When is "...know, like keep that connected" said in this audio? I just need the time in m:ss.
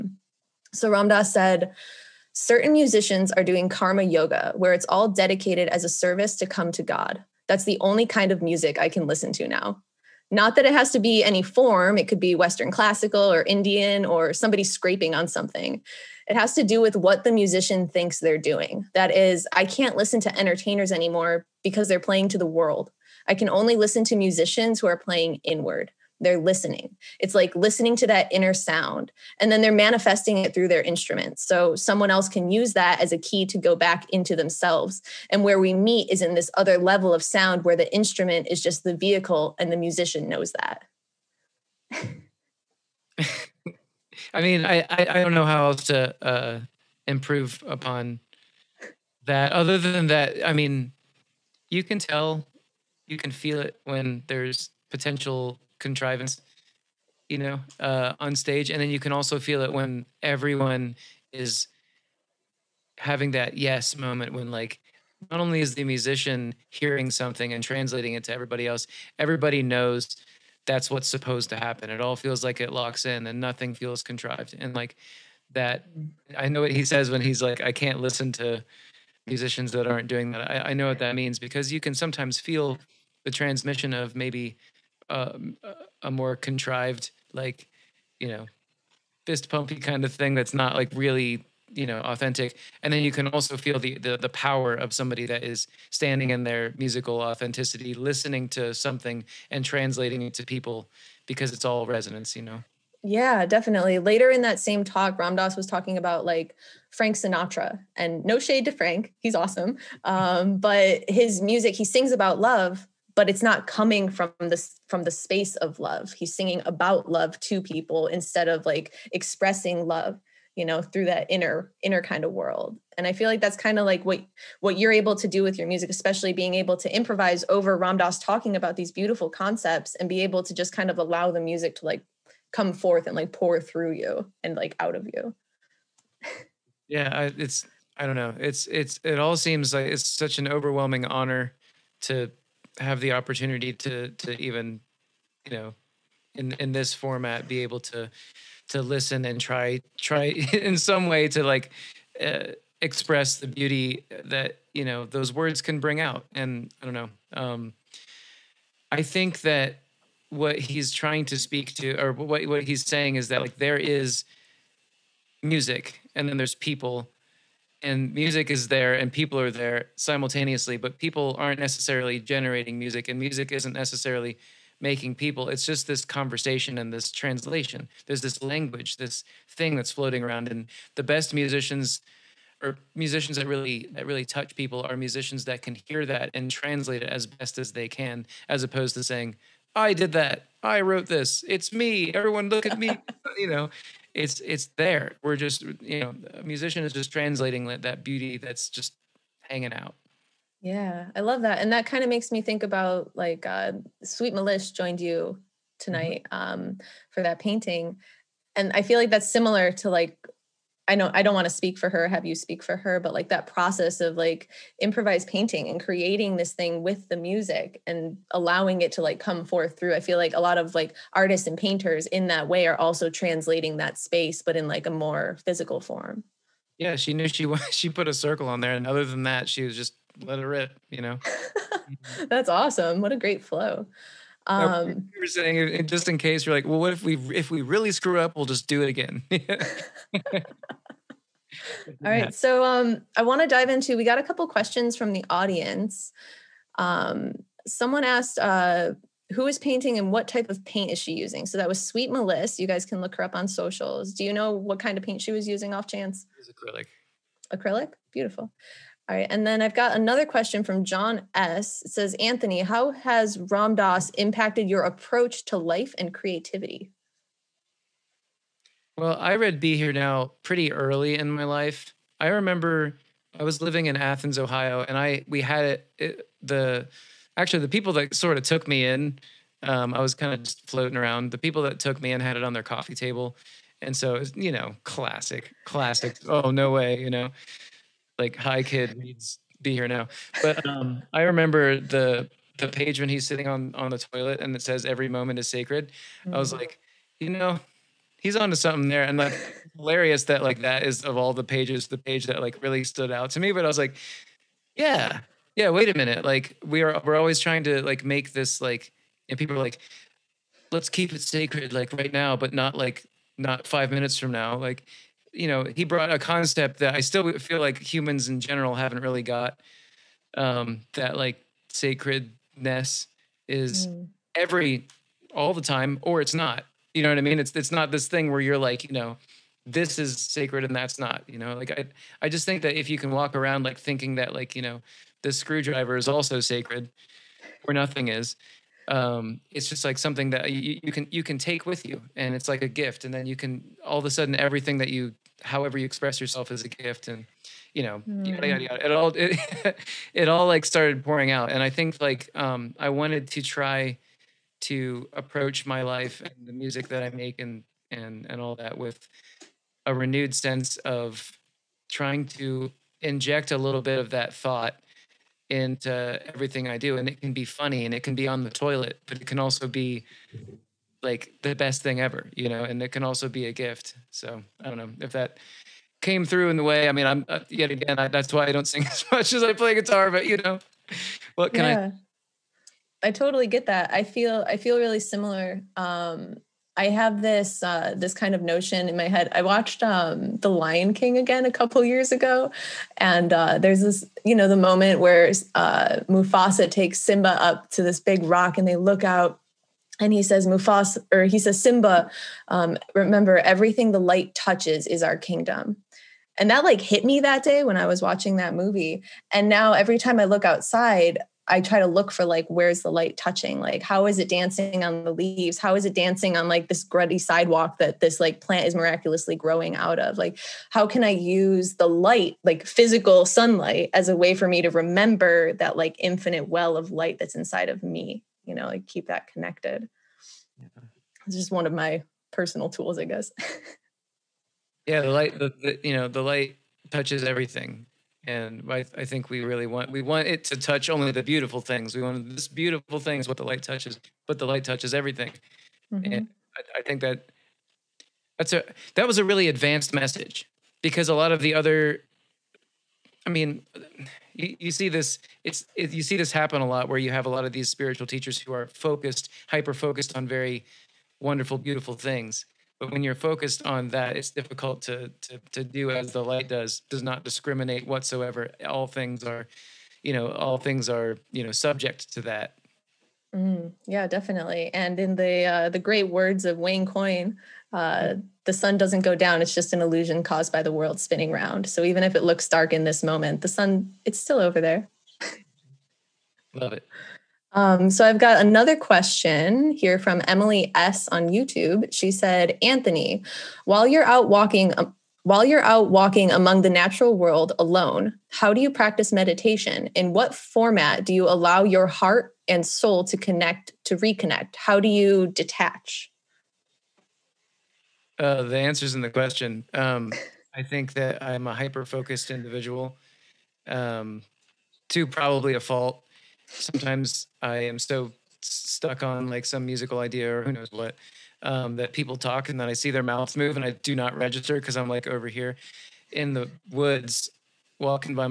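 7:08.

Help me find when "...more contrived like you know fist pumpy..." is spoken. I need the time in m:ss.
1:26.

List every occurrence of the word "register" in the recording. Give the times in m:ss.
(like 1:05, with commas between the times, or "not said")
8:44.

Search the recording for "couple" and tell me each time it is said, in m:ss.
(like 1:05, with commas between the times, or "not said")
4:04, 6:31.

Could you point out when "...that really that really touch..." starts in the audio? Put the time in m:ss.
3:03.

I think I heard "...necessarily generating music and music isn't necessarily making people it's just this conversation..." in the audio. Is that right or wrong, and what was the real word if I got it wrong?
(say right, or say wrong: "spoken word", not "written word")
right.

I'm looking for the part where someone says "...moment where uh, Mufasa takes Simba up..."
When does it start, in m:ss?
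6:34.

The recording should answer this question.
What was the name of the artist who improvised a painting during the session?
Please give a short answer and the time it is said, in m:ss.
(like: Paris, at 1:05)
Sweet Melissa, at 4:11.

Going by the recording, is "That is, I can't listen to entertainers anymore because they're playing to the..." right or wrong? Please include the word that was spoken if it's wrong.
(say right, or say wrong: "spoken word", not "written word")
right.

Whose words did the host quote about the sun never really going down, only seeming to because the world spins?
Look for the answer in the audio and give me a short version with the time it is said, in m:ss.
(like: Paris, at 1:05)
Wayne Coyne, at 7:56.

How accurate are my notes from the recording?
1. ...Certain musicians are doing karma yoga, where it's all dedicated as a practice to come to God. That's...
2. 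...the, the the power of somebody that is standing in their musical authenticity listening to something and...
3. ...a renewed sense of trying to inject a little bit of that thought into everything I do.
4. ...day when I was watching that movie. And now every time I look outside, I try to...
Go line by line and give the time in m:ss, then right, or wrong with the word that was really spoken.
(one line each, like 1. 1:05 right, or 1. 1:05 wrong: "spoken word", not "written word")
1. 0:02 wrong: "service", not "practice"
2. 1:33 right
3. 5:59 right
4. 6:47 right.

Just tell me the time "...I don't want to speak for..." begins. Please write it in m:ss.
3:31.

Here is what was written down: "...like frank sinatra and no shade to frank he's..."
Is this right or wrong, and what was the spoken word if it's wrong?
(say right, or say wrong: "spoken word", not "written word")
right.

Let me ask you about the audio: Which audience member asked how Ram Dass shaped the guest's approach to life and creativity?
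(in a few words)
John S.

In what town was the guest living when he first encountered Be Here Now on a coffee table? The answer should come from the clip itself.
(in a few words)
Athens, Ohio.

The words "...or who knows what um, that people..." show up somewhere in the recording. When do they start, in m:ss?
8:40.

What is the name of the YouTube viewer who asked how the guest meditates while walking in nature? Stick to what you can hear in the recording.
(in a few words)
Emily S.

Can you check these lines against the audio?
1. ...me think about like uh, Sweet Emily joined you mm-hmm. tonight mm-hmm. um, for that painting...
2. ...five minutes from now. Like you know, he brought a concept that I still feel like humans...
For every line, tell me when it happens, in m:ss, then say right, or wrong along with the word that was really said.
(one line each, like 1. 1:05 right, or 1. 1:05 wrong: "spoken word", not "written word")
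1. 3:22 wrong: "Melis", not "Emily"
2. 5:13 right.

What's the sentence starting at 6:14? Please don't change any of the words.
So I don't know if that came through in the way.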